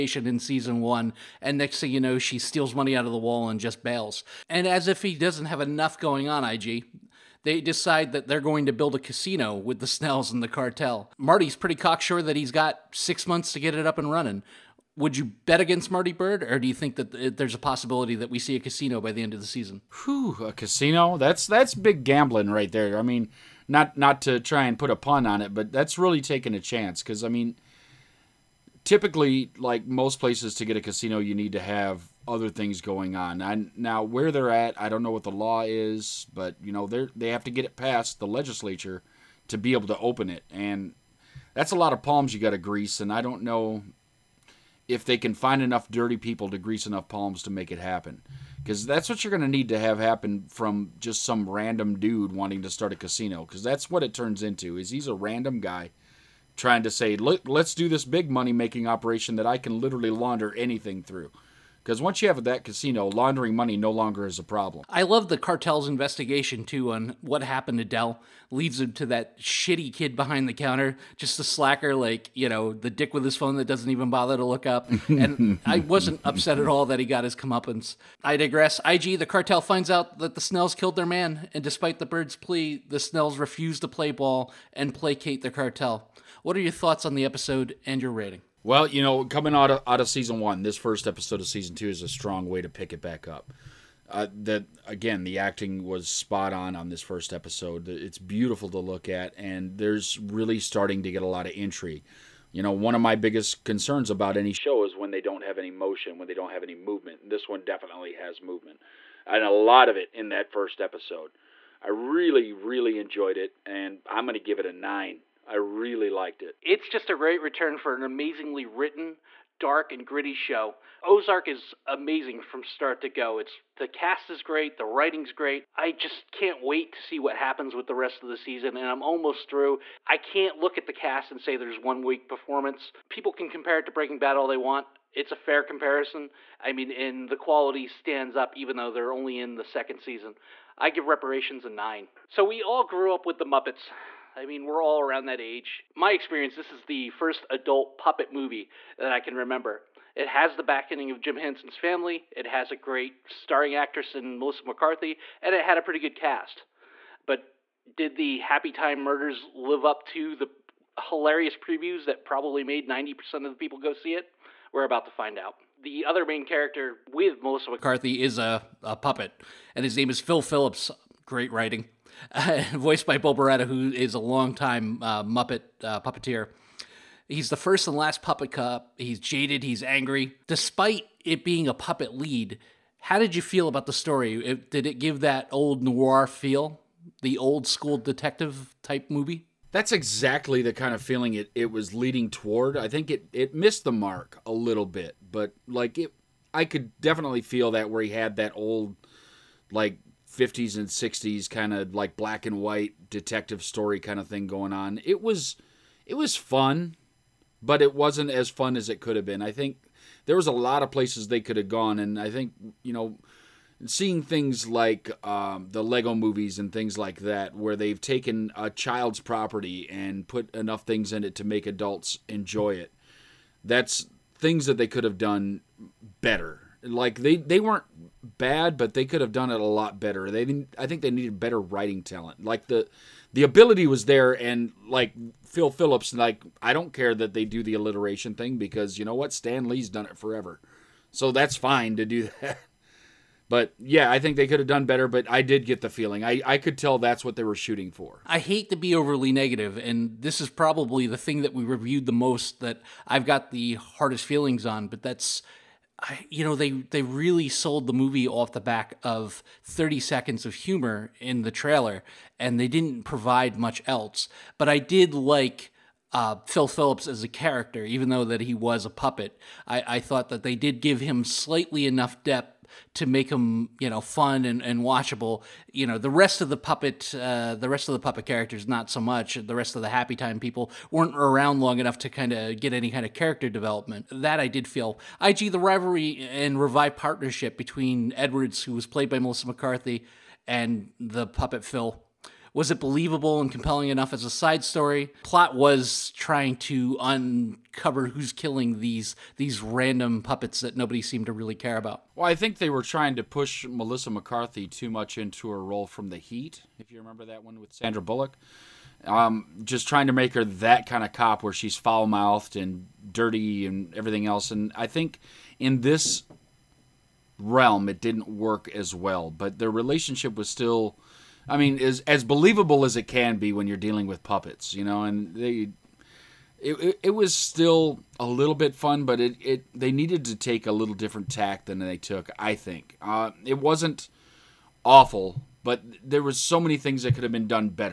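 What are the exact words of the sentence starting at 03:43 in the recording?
That's things that they could have done better.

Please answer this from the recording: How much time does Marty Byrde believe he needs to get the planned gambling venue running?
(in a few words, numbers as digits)
6 months.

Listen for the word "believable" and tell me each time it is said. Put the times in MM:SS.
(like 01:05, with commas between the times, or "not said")
04:52, 05:22.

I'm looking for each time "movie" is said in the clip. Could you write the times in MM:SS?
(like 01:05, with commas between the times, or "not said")
02:28, 03:09, 03:36, 04:17.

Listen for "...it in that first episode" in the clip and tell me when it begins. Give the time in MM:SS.
01:49.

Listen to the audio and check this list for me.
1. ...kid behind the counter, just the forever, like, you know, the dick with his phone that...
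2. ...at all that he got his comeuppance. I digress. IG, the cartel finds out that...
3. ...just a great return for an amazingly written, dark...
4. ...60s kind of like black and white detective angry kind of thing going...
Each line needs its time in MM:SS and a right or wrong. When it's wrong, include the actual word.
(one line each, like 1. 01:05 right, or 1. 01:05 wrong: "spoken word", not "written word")
1. 01:09 wrong: "slacker", not "forever"
2. 01:16 right
3. 01:56 right
4. 03:20 wrong: "story", not "angry".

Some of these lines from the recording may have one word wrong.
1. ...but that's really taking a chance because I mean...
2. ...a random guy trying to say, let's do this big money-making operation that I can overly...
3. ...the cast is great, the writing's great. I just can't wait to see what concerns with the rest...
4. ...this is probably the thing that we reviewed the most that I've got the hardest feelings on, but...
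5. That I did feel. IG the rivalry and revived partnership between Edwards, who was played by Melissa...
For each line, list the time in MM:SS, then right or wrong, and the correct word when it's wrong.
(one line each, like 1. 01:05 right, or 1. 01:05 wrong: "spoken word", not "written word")
1. 00:25 right
2. 00:55 wrong: "literally", not "overly"
3. 02:03 wrong: "happens", not "concerns"
4. 04:10 right
5. 04:44 right.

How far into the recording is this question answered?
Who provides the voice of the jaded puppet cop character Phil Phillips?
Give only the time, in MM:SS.
02:53.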